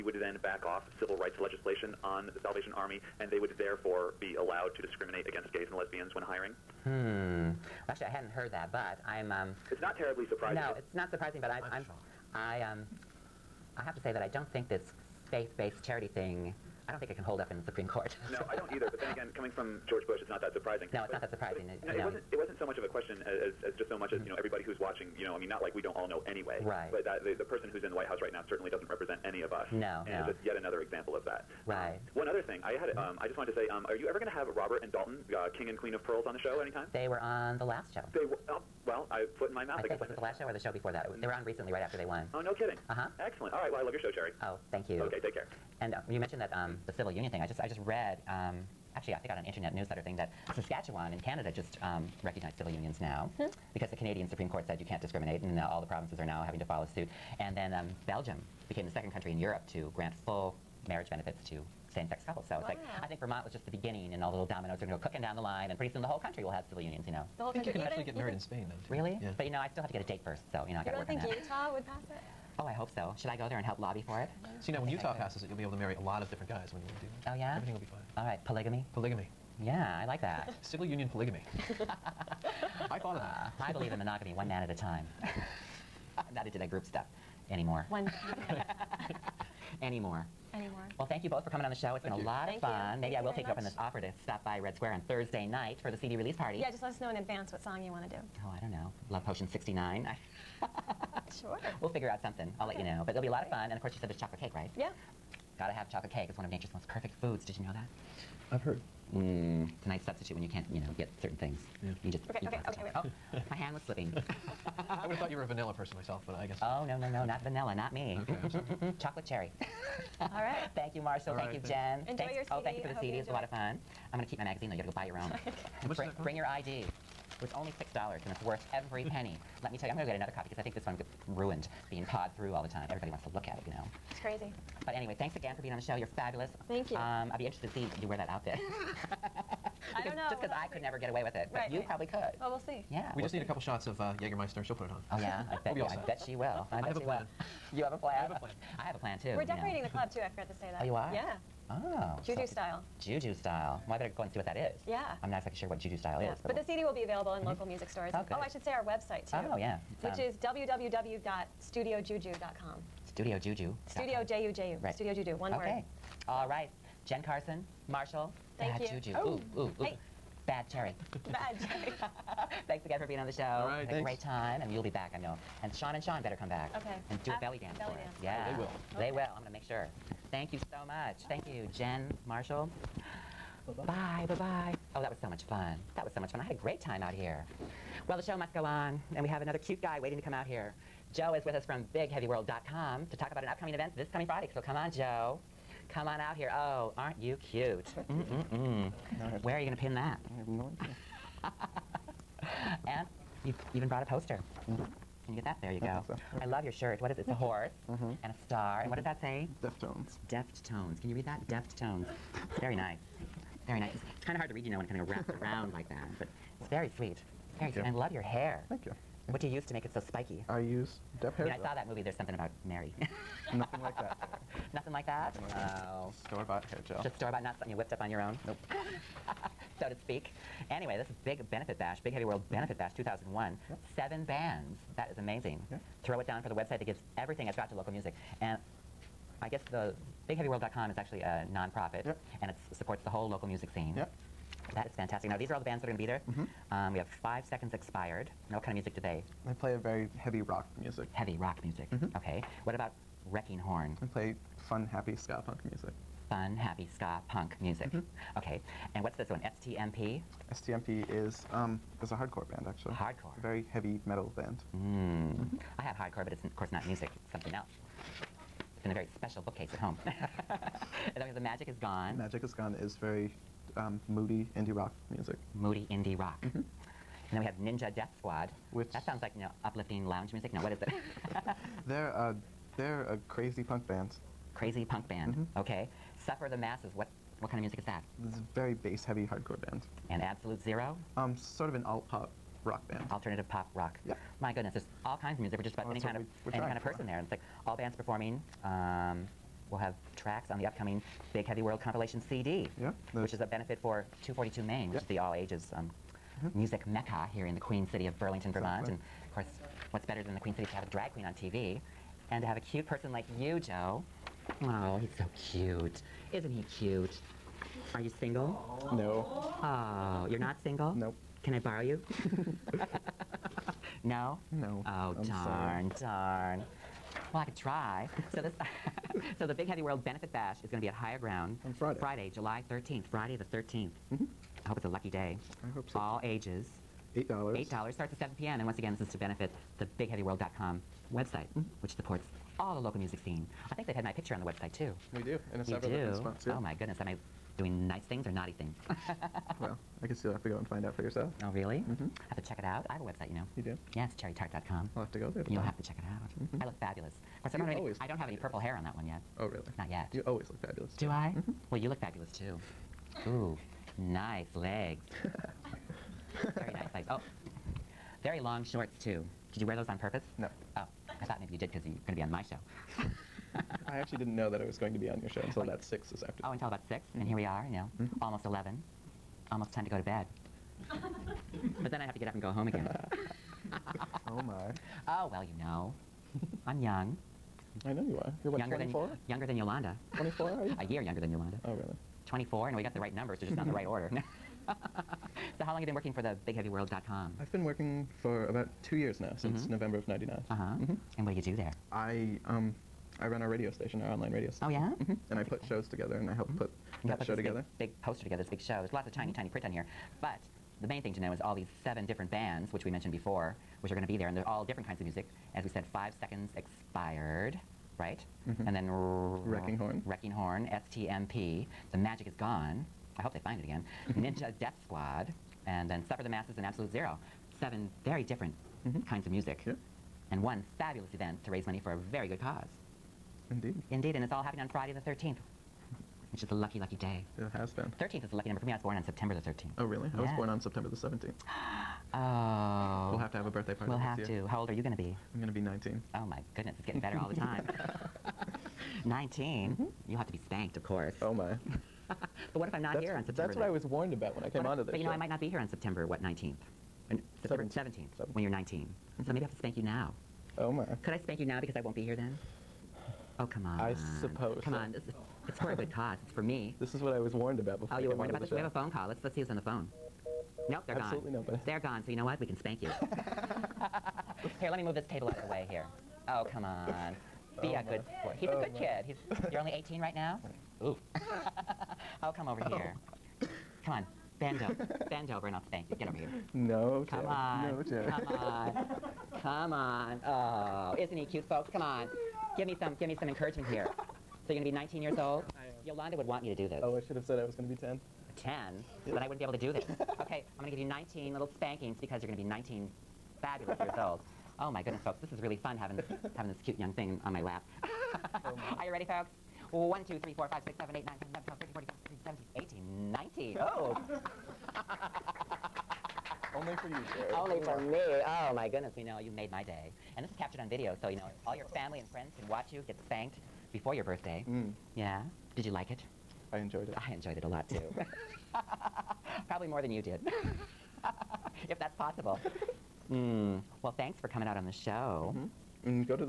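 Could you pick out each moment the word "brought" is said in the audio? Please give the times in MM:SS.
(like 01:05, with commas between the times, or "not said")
03:23.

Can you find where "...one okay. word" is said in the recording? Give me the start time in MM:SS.
02:45.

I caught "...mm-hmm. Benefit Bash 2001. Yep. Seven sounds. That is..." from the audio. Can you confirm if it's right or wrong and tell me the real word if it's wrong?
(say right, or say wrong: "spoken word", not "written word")
wrong: "bands", not "sounds".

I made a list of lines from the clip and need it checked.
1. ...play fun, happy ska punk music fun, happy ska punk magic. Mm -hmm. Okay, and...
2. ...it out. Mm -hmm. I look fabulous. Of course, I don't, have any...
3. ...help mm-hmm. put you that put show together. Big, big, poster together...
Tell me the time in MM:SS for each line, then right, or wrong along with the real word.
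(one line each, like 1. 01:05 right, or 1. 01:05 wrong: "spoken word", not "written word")
1. 04:14 wrong: "music", not "magic"
2. 05:55 right
3. 06:46 right.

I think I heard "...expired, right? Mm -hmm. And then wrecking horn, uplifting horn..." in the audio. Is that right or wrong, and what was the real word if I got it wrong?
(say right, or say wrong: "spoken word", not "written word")
wrong: "wrecking", not "uplifting".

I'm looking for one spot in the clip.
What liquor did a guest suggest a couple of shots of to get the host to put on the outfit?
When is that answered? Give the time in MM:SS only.
02:24.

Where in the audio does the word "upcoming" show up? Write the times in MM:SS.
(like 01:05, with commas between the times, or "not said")
03:13, 05:00.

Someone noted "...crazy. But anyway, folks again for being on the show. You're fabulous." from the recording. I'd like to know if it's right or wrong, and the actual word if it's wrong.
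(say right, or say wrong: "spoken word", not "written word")
wrong: "thanks", not "folks".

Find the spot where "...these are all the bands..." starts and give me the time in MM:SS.
04:05.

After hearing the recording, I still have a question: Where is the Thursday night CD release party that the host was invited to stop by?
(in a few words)
Red Square.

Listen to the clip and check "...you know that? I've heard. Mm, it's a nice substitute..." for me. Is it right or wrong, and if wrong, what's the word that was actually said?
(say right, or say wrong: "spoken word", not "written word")
right.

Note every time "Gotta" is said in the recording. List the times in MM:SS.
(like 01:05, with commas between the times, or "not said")
01:45.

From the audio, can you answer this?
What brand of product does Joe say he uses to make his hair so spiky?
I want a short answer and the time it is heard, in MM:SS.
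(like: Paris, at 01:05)
Dep, at 03:41.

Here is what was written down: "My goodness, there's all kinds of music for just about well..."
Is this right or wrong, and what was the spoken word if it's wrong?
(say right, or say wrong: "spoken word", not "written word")
right.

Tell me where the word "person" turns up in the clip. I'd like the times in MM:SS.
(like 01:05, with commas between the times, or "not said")
00:27, 01:55, 04:56, 05:12.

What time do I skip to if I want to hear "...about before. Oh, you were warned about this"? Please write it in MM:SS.
07:47.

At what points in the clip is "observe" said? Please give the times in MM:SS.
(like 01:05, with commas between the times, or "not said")
not said.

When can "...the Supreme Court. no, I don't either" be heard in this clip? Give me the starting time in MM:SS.
00:17.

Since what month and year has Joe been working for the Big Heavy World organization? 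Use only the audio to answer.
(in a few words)
November 1999.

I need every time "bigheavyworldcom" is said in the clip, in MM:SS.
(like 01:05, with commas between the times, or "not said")
03:11, 04:00, 05:39, 06:36.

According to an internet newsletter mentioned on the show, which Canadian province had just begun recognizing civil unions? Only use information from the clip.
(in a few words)
Saskatchewan.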